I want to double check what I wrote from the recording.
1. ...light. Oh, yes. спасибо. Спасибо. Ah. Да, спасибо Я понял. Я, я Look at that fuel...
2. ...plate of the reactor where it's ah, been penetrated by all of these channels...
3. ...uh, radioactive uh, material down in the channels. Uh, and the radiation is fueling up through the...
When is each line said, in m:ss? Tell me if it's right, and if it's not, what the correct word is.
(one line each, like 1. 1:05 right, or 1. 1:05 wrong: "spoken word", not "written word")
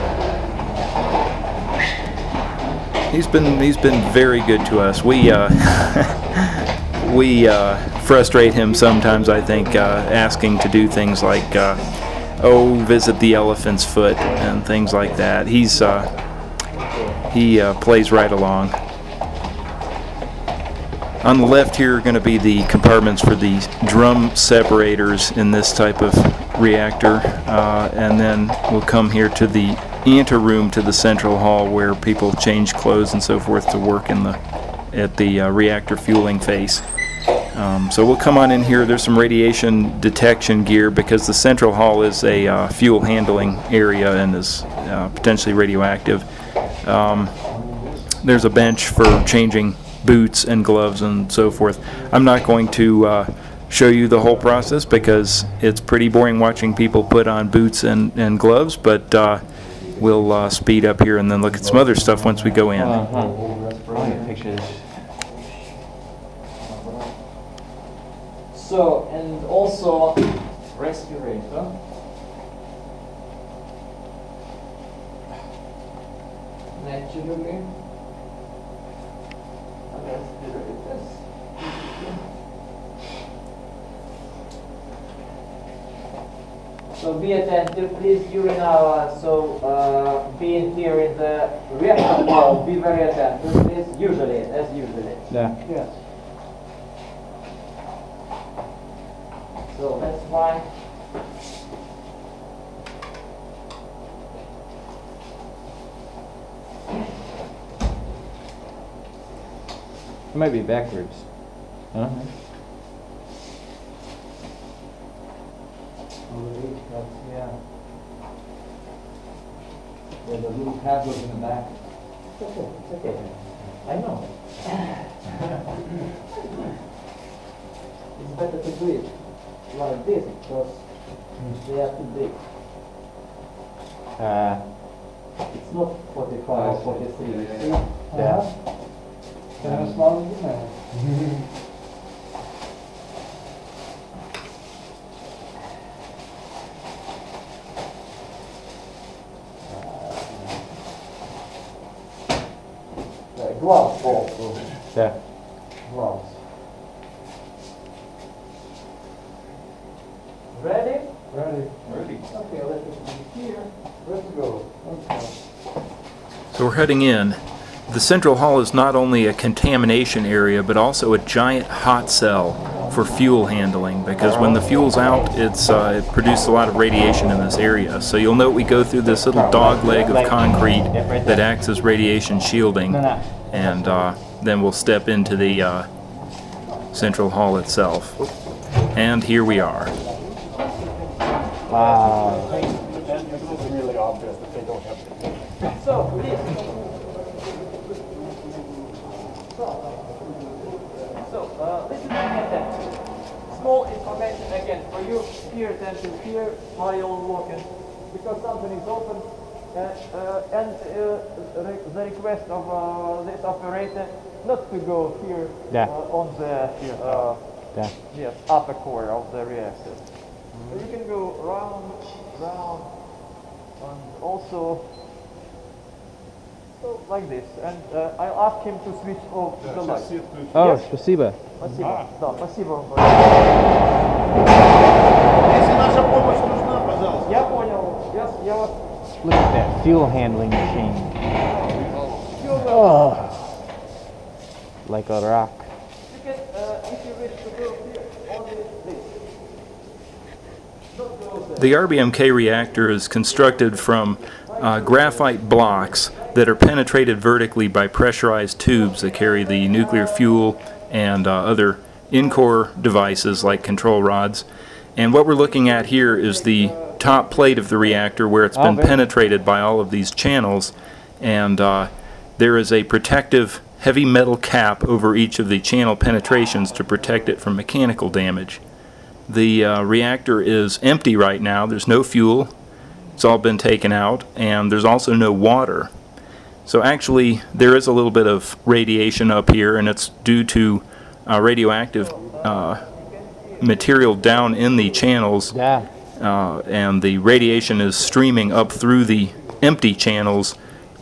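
1. 3:49 right
2. 4:27 right
3. 4:51 wrong: "streaming", not "fueling".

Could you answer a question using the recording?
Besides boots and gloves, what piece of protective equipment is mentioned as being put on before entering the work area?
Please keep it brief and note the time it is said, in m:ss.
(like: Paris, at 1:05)
Respirator, at 1:10.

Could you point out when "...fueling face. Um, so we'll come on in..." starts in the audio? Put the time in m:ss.
0:35.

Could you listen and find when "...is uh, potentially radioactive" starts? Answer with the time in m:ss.
0:44.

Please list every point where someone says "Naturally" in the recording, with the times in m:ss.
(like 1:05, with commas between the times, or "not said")
1:16.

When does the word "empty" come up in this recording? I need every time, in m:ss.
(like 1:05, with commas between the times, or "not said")
4:40, 4:59.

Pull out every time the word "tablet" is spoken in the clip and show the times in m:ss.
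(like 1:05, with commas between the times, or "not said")
2:00.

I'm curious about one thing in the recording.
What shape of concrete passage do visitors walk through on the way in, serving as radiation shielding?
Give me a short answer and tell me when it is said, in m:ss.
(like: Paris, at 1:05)
Dog leg, at 2:59.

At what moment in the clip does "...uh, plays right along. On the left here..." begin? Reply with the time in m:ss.
0:17.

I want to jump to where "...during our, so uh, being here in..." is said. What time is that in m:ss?
1:28.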